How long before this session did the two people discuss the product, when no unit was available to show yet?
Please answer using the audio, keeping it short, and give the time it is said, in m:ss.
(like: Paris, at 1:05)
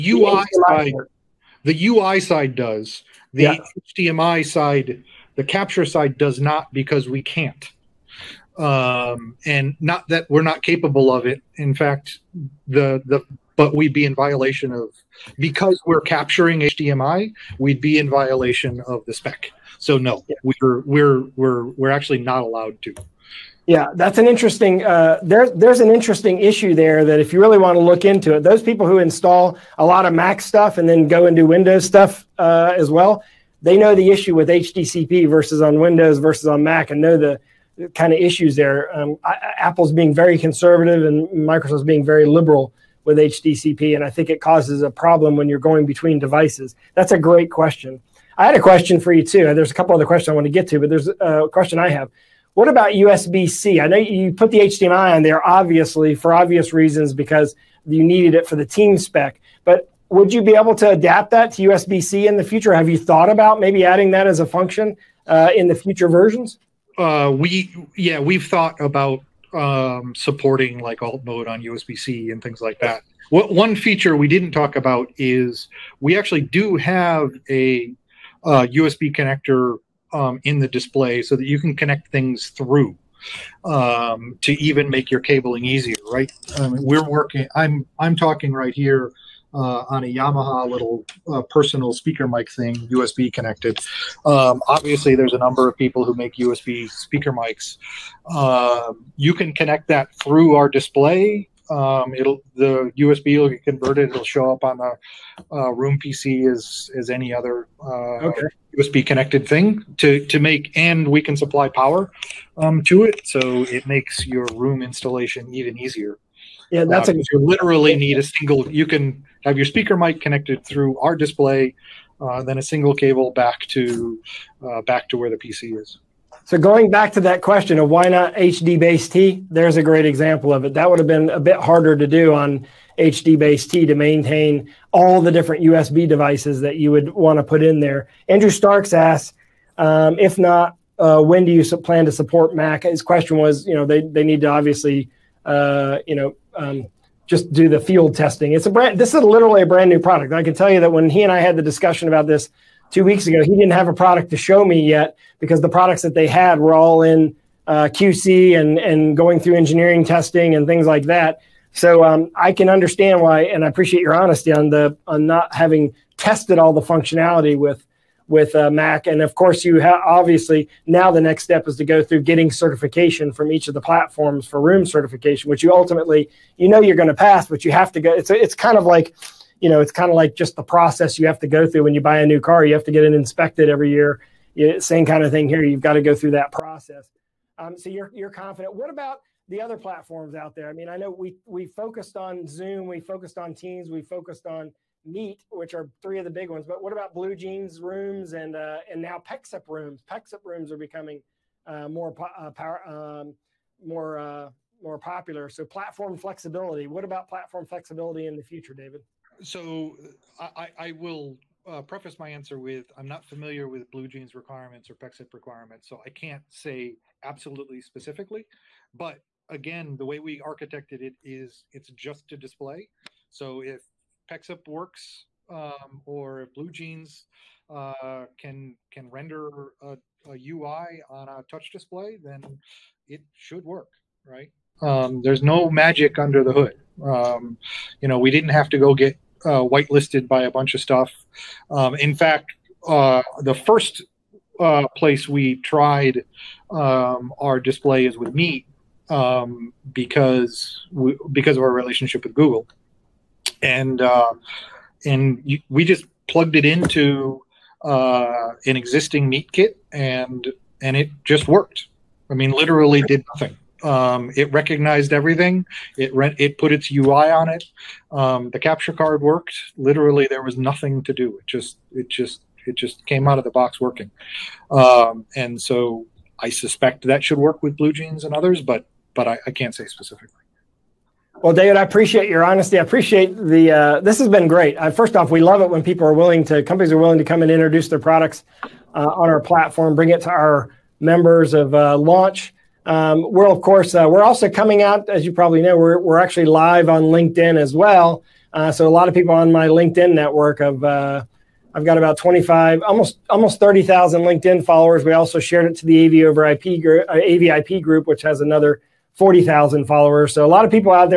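two weeks ago, at 2:32.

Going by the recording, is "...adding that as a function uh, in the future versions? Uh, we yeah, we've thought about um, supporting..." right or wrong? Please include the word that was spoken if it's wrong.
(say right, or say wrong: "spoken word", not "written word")
right.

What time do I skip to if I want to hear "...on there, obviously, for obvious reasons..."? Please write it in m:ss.
0:55.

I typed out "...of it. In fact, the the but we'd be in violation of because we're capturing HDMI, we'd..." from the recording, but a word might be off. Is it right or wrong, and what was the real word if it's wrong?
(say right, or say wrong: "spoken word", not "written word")
right.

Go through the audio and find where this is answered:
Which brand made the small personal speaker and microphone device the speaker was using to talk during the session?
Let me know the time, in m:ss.
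1:30.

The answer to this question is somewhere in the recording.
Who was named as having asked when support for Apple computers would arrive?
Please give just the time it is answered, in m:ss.
2:18.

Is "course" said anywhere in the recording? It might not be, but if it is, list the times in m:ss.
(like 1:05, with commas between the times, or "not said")
2:49, 4:53.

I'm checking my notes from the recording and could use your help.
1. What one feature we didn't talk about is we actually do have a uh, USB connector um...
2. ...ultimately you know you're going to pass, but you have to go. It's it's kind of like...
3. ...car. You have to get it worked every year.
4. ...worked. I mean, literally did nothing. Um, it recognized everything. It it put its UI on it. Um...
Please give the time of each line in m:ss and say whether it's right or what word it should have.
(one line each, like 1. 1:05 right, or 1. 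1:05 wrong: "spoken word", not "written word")
1. 1:13 right
2. 2:55 right
3. 3:02 wrong: "inspected", not "worked"
4. 4:21 right.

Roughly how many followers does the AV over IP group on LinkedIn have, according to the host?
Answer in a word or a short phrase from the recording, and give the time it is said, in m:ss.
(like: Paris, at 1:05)
40,000, at 5:09.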